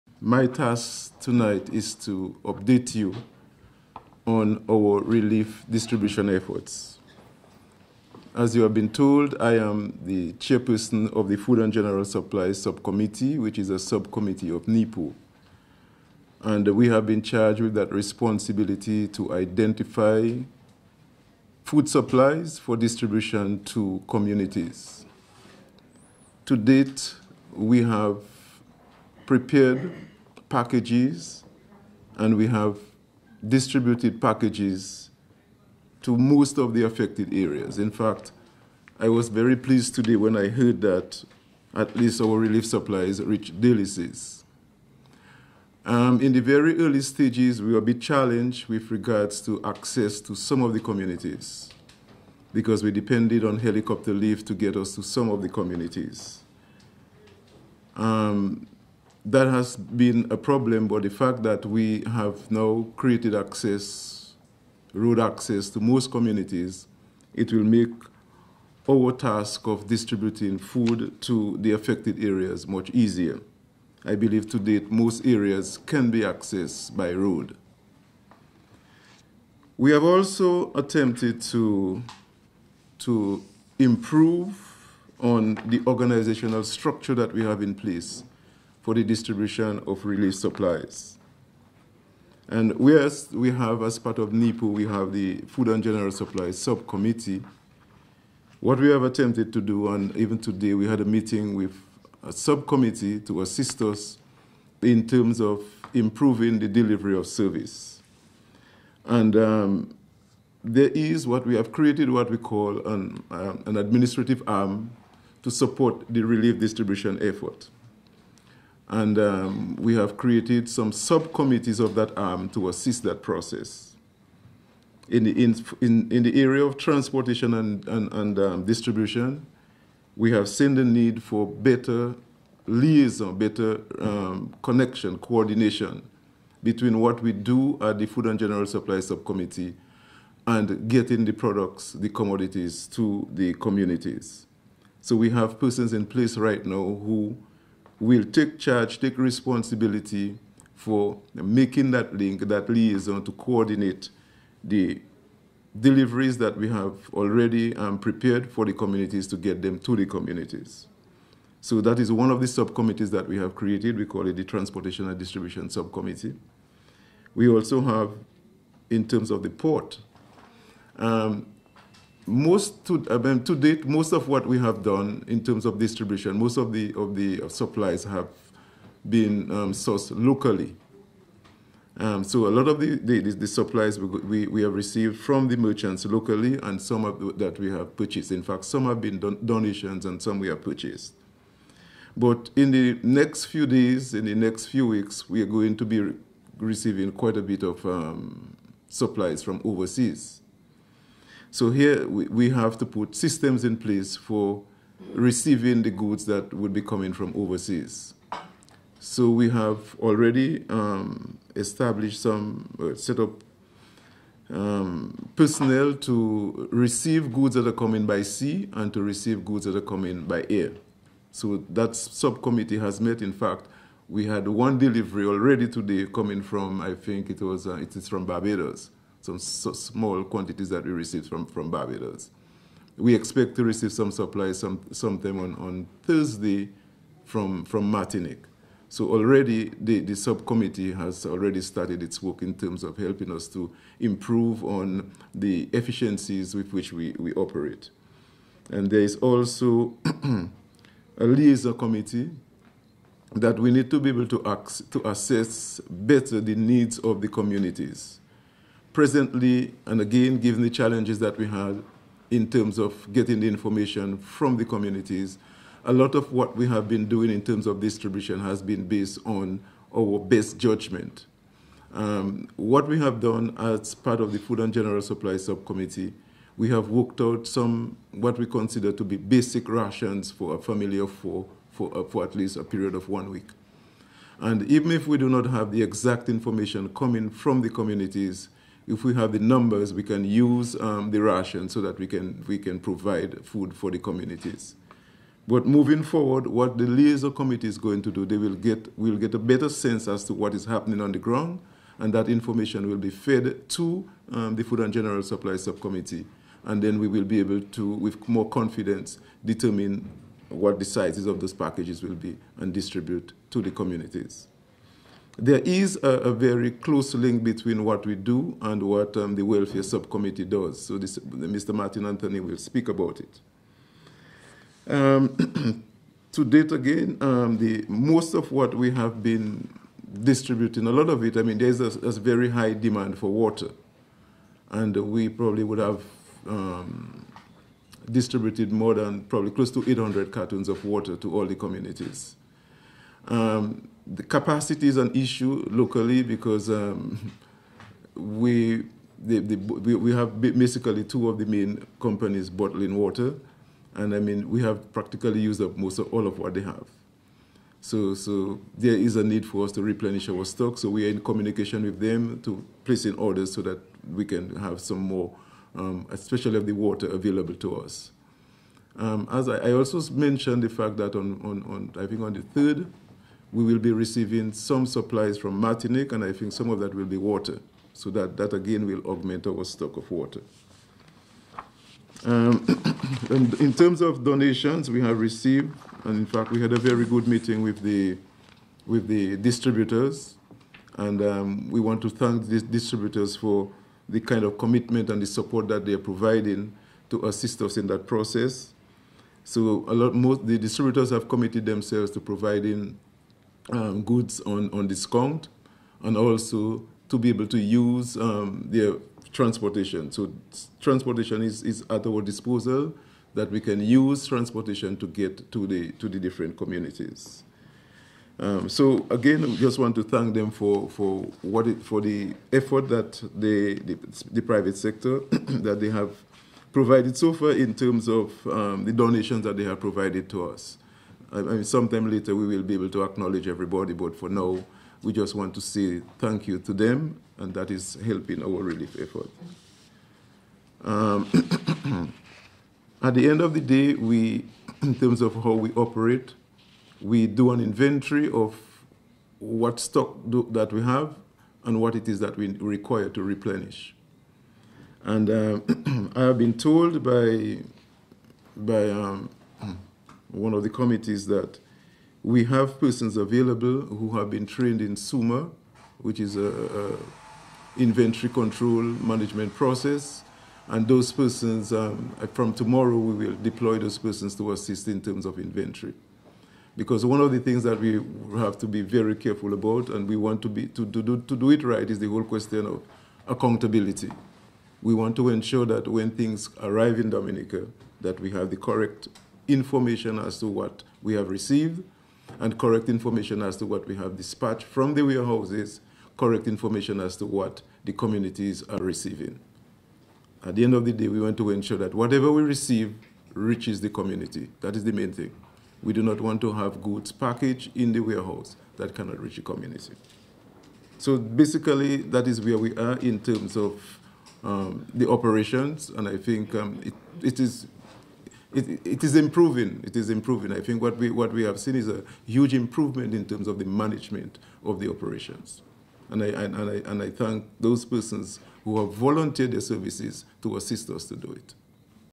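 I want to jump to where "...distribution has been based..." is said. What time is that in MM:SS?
04:27.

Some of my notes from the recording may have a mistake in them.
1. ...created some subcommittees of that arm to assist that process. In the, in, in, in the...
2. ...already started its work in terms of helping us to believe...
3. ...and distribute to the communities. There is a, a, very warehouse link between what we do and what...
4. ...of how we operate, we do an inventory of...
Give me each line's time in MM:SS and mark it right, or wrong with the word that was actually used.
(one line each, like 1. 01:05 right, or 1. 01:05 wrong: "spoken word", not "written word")
1. 02:00 right
2. 04:01 wrong: "improve", not "believe"
3. 05:12 wrong: "close", not "warehouse"
4. 07:25 right.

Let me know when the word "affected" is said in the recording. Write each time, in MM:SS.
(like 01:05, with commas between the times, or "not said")
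00:36, 01:11.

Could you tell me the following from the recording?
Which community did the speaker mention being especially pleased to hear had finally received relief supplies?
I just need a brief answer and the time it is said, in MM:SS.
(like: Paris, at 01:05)
Delices, at 00:43.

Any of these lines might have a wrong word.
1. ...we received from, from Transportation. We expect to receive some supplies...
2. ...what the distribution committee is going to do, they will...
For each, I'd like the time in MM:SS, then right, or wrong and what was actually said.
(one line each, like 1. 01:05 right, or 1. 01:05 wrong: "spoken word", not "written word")
1. 03:50 wrong: "Barbados", not "Transportation"
2. 04:56 wrong: "liaison", not "distribution".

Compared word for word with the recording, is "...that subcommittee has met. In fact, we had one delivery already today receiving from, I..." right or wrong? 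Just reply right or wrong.
wrong.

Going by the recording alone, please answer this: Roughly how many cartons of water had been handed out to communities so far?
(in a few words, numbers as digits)
800.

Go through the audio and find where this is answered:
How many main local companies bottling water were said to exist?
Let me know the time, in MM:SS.
05:51.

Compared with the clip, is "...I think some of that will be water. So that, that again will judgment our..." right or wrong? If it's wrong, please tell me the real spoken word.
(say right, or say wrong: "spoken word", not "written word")
wrong: "augment", not "judgment".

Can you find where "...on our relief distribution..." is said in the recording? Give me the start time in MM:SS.
00:04.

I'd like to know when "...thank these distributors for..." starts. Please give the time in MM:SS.
06:32.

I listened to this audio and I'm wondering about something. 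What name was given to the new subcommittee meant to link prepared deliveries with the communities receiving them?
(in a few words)
Transportation and Distribution Subcommittee.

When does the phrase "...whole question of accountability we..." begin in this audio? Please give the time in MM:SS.
08:02.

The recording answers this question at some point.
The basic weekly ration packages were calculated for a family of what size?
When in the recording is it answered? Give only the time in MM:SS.
04:41.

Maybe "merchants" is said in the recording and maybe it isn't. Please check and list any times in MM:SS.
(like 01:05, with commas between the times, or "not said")
03:05.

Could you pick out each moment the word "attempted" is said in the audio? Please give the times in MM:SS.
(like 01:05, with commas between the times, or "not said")
01:20, 01:39.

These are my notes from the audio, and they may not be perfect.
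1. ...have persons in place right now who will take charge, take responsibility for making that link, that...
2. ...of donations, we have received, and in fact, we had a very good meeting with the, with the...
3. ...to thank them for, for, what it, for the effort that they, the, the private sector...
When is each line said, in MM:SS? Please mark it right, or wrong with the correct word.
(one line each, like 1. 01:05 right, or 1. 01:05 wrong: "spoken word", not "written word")
1. 02:25 right
2. 06:24 right
3. 06:59 right.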